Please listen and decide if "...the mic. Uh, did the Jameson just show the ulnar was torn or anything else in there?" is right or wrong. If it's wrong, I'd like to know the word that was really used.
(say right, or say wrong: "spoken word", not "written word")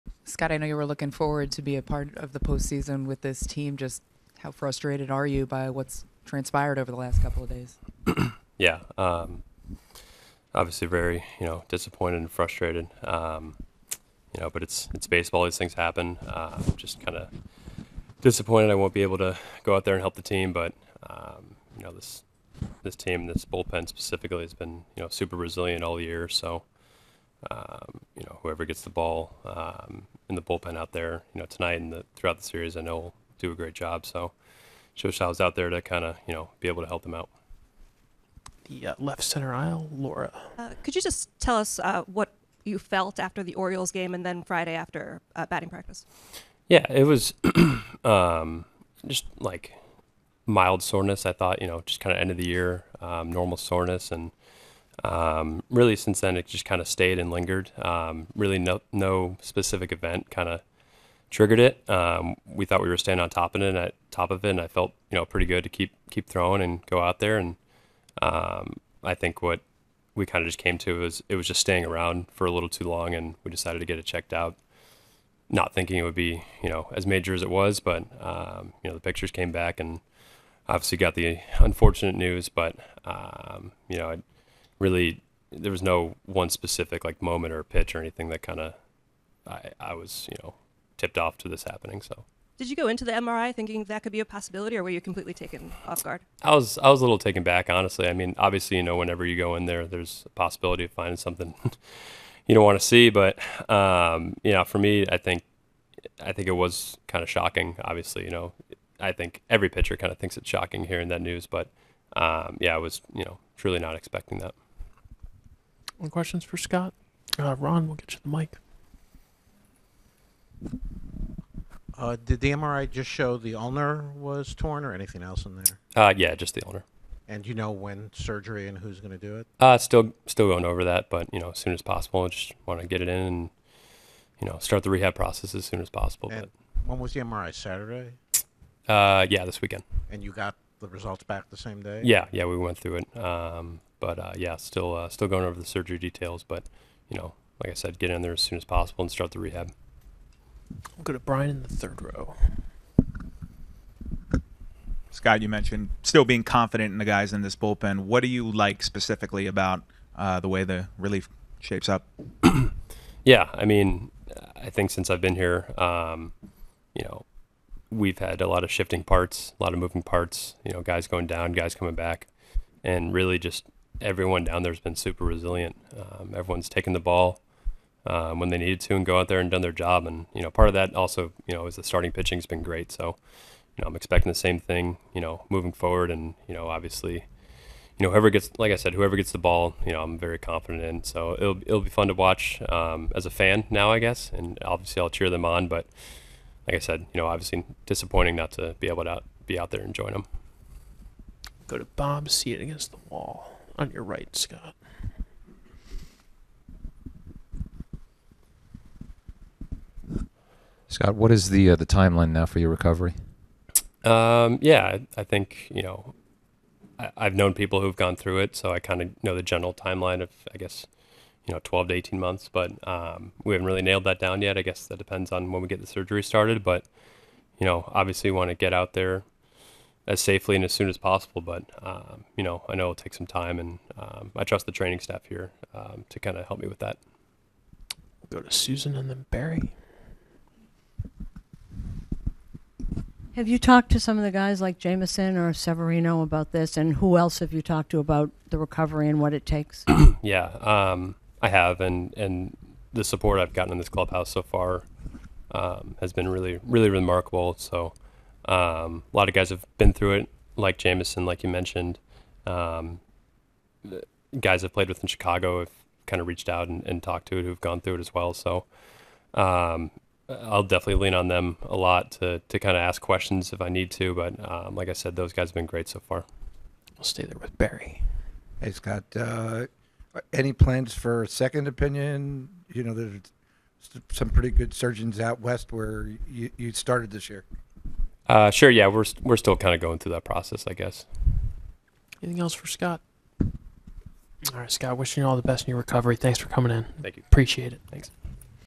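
wrong: "MRI", not "Jameson".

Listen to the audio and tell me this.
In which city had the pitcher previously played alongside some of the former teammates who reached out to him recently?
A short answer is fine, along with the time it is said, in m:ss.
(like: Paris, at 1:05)
Chicago, at 4:25.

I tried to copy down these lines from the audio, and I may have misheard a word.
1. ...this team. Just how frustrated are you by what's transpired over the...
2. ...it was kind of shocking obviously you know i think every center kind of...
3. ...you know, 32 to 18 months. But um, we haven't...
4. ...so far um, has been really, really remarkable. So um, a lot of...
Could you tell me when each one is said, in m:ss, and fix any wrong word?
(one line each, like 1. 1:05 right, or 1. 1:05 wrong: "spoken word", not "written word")
1. 0:03 right
2. 1:46 wrong: "pitcher", not "center"
3. 3:41 wrong: "12", not "32"
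4. 4:14 right.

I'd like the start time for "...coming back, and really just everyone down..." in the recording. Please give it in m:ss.
2:51.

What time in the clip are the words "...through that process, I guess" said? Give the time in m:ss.
4:49.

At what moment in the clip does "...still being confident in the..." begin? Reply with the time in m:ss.
2:36.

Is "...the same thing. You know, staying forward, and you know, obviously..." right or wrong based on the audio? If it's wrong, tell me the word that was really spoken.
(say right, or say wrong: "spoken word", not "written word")
wrong: "moving", not "staying".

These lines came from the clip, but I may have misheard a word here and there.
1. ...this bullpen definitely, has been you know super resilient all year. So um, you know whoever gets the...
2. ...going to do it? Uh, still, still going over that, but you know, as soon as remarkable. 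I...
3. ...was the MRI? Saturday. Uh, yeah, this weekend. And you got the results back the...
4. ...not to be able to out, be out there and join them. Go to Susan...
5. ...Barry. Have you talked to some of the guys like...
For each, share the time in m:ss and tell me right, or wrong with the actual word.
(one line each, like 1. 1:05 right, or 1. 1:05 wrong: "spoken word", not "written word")
1. 0:23 wrong: "specifically", not "definitely"
2. 2:08 wrong: "possible", not "remarkable"
3. 2:16 right
4. 3:18 wrong: "Bob", not "Susan"
5. 3:59 right.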